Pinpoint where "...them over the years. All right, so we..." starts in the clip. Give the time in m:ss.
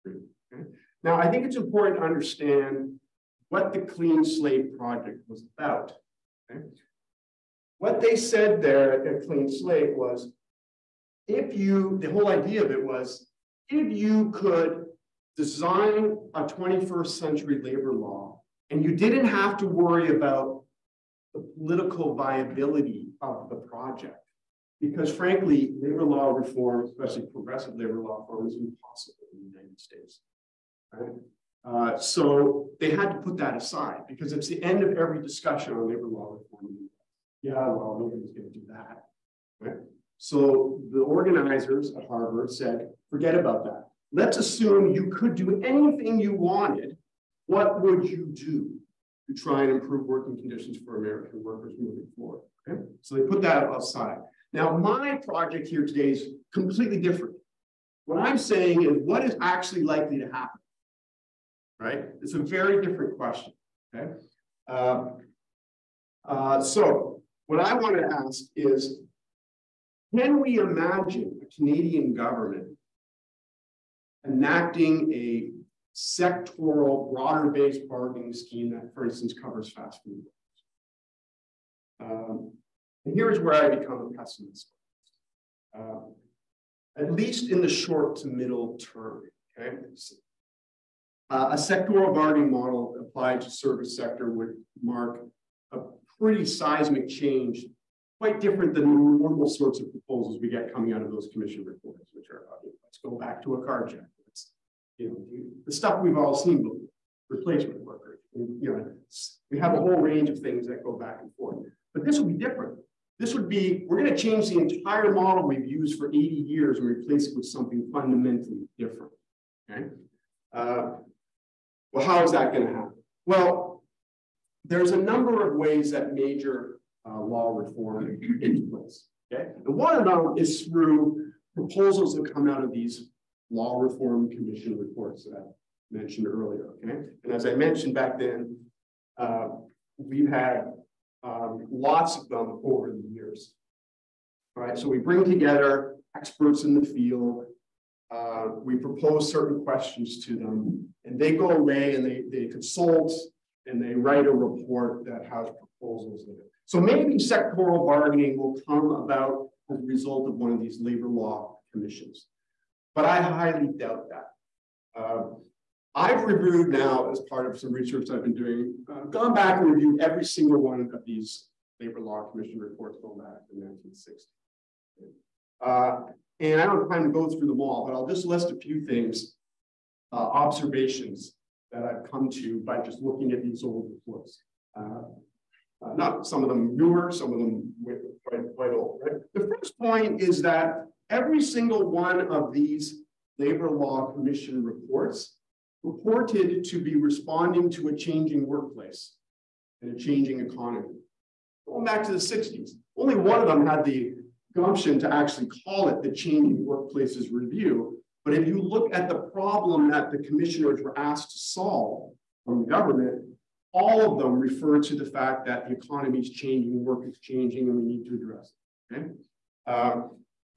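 2:22.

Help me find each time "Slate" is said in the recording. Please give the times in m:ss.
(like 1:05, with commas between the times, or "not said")
0:04, 0:09.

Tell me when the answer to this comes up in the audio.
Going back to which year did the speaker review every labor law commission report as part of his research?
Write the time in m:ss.
2:53.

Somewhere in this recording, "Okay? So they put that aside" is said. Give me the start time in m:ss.
0:52.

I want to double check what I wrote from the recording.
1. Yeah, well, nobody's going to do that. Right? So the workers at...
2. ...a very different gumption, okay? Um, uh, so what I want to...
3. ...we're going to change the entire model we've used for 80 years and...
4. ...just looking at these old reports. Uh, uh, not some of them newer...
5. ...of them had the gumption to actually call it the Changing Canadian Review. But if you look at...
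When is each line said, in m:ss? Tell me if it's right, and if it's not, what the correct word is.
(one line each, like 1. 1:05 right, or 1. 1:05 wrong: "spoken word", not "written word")
1. 0:37 wrong: "organizers", not "workers"
2. 1:02 wrong: "question", not "gumption"
3. 1:53 right
4. 3:02 right
5. 3:23 wrong: "Workplaces", not "Canadian".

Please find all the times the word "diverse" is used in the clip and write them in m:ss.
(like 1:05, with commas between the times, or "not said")
not said.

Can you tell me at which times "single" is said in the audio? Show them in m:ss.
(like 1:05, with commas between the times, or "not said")
2:50, 3:11.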